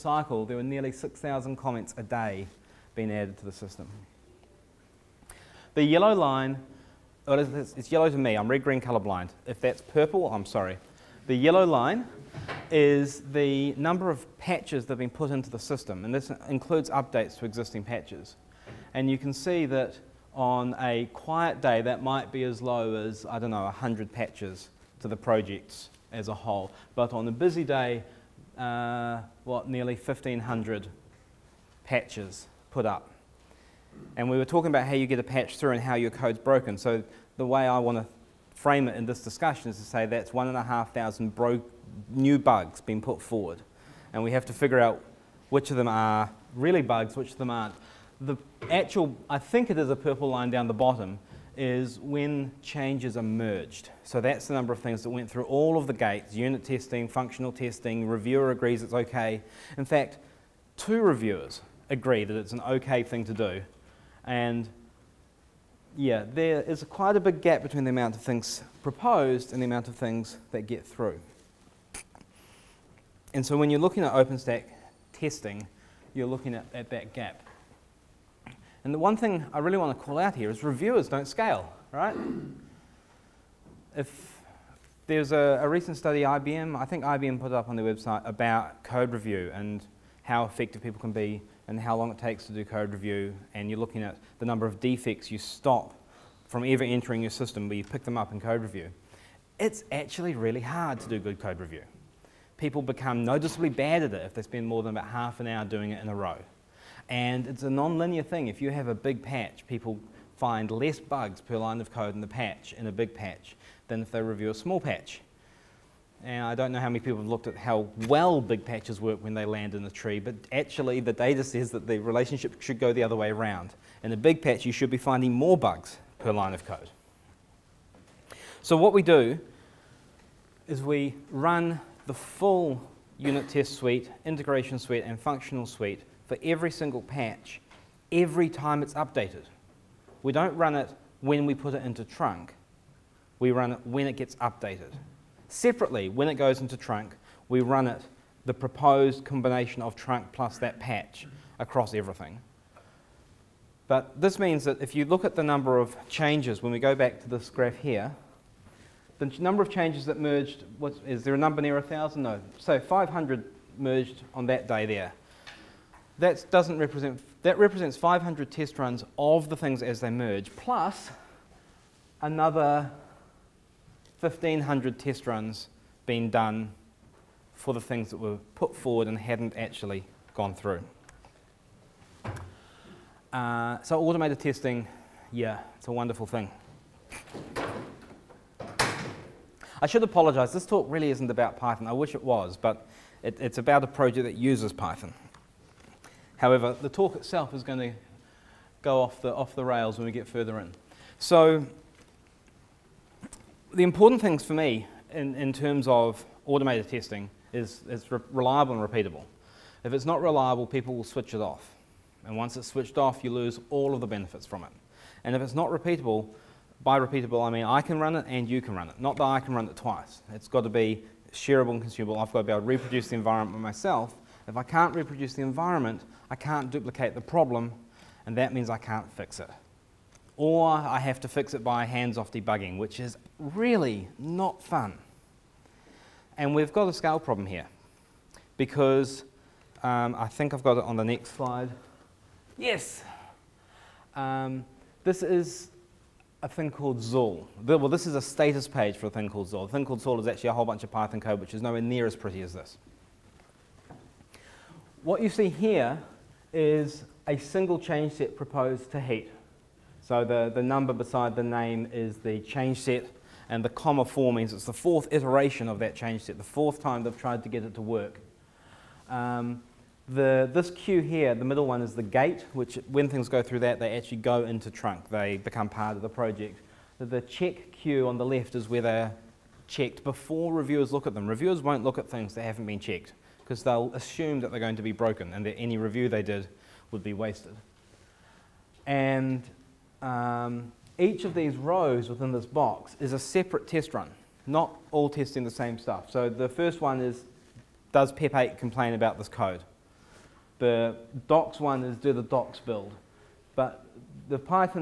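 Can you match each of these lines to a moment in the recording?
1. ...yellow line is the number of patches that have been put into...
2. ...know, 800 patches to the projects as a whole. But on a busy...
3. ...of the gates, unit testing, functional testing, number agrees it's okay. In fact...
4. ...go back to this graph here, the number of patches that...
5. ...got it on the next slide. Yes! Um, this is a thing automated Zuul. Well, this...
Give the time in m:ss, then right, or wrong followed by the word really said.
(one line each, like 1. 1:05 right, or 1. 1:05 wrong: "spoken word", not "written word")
1. 0:11 right
2. 0:23 wrong: "100", not "800"
3. 0:55 wrong: "reviewer", not "number"
4. 2:36 wrong: "changes", not "patches"
5. 4:00 wrong: "called", not "automated".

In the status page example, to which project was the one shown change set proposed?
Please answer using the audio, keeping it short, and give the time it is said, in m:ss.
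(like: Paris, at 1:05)
heat, at 4:19.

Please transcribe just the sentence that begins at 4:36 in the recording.
The check queue on the left is where they're checked before reviewers look at them.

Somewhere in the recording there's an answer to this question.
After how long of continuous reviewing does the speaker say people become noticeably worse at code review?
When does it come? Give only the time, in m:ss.
1:45.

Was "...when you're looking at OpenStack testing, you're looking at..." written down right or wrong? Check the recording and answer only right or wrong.
right.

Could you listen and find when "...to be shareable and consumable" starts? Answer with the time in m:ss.
3:40.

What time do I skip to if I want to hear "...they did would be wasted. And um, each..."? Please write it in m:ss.
4:46.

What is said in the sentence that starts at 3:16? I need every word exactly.
However, the talk itself is going to go off the, off the rails when we get further in.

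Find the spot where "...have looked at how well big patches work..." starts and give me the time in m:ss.
1:57.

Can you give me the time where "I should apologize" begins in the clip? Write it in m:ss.
3:09.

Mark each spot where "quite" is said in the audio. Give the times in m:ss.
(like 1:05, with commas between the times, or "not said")
1:06.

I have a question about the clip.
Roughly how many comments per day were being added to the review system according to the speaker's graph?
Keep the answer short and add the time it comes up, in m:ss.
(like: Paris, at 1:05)
6,000, at 0:00.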